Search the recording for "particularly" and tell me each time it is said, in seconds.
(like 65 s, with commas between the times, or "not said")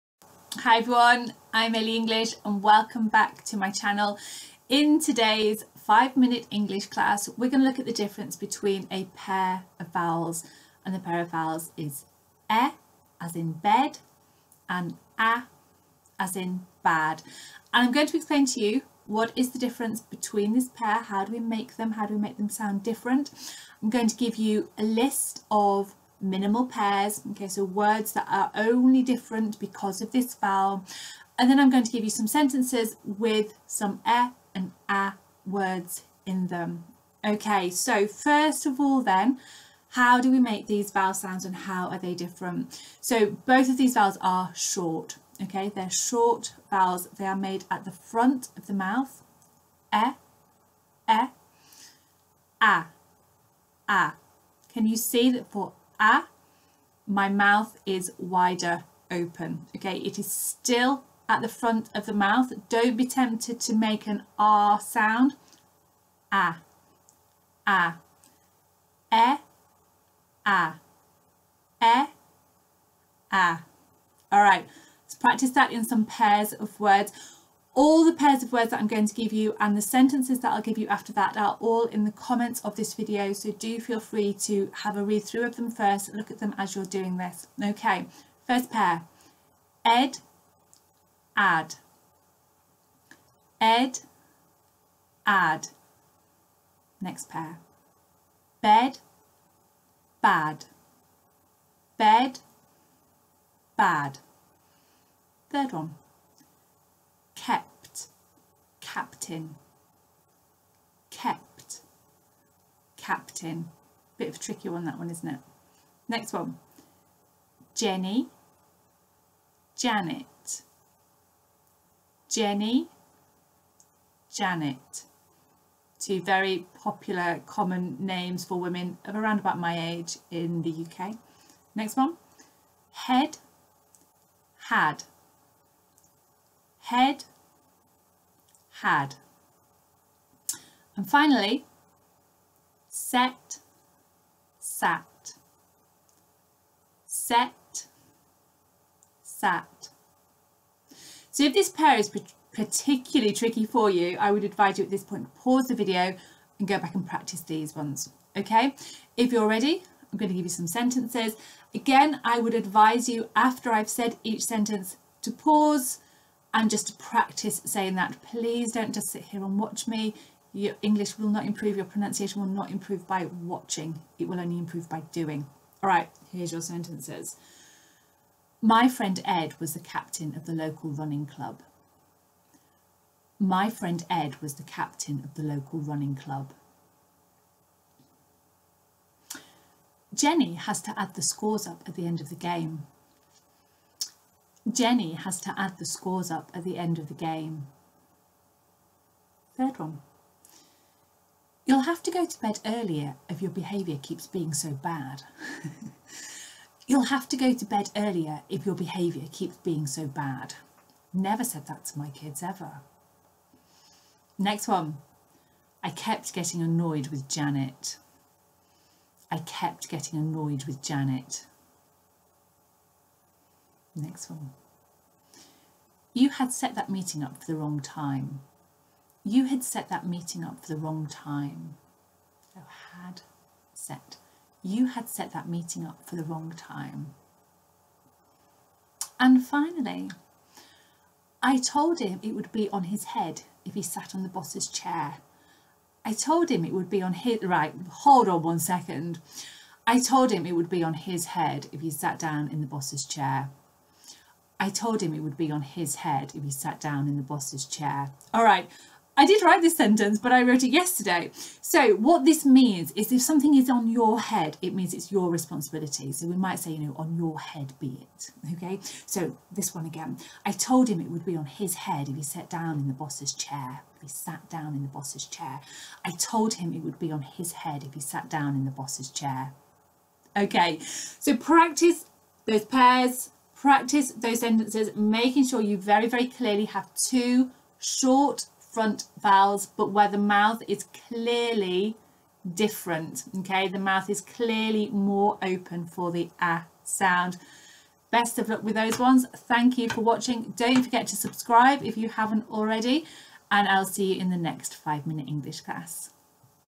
152 s.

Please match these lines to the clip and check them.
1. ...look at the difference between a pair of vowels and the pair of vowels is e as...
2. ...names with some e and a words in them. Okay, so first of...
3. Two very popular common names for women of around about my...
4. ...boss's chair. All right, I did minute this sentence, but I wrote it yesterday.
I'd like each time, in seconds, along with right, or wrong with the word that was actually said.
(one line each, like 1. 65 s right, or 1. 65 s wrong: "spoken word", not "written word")
1. 7 s right
2. 32 s wrong: "sentences", not "names"
3. 125 s right
4. 257 s wrong: "write", not "minute".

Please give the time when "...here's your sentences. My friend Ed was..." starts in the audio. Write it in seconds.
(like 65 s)
176 s.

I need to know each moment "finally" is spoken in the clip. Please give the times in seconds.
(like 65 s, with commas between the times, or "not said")
141 s, 239 s.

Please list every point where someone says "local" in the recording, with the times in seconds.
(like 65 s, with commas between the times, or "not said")
180 s, 185 s.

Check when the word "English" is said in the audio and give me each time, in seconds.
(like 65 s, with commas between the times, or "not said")
1 s, 6 s, 170 s, 305 s.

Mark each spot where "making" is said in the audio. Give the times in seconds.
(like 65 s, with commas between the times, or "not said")
284 s.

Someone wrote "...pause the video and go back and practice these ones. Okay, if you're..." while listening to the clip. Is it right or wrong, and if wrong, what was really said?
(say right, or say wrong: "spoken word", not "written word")
right.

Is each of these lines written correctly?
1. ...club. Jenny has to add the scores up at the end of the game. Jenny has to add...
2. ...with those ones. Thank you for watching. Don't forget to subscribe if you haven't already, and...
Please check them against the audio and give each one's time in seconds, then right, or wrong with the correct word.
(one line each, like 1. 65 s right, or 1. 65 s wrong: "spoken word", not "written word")
1. 186 s right
2. 298 s right.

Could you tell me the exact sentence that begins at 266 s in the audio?
So we might say, you know, on your head be it.